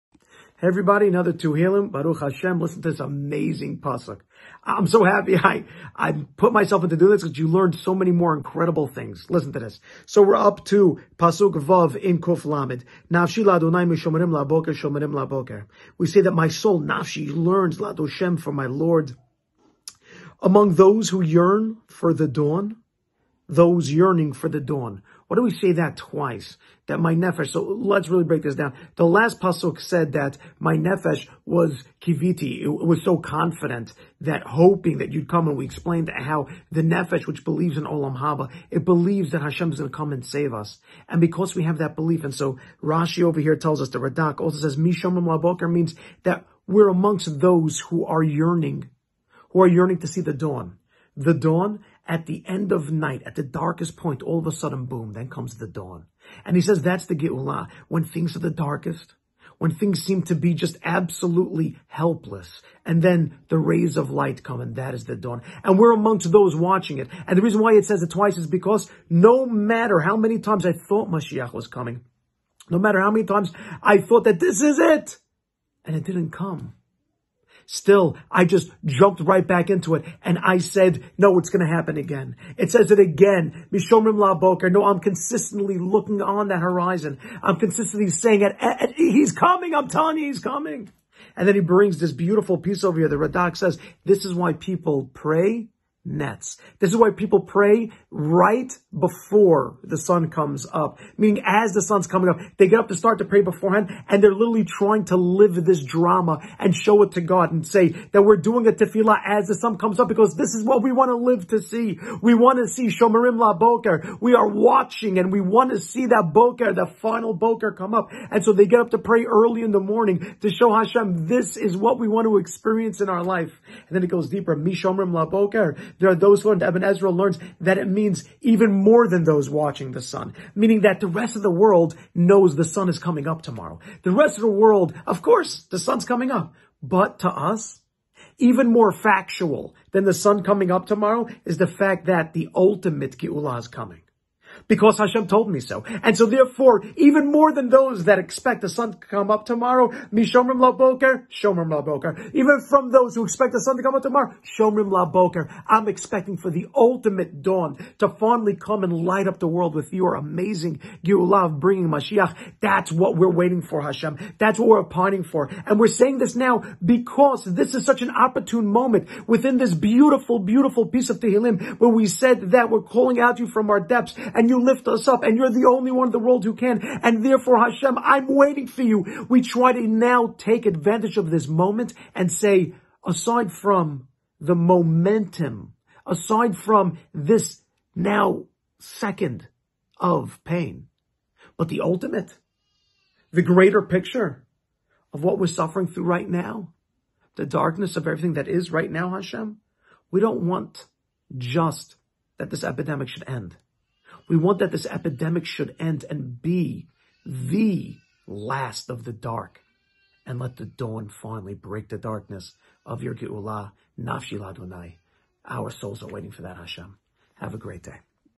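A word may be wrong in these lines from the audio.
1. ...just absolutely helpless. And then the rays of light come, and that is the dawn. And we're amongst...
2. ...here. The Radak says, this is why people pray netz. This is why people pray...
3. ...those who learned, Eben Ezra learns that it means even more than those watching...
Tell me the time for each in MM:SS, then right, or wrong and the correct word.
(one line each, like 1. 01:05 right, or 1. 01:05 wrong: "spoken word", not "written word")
1. 01:00 right
2. 01:32 right
3. 02:06 right.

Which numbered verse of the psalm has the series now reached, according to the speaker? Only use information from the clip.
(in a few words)
Vav.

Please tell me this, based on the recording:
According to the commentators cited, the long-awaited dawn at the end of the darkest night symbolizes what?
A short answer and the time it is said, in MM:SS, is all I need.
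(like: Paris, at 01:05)
The Geulah, at 00:57.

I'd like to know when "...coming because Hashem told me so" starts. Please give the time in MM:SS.
02:23.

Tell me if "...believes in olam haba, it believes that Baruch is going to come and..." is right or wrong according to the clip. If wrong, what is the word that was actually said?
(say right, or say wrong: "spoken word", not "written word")
wrong: "Hashem", not "Baruch".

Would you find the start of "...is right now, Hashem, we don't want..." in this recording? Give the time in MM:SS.
03:18.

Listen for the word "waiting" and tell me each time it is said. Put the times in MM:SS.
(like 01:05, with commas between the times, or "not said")
02:43, 02:58, 03:36.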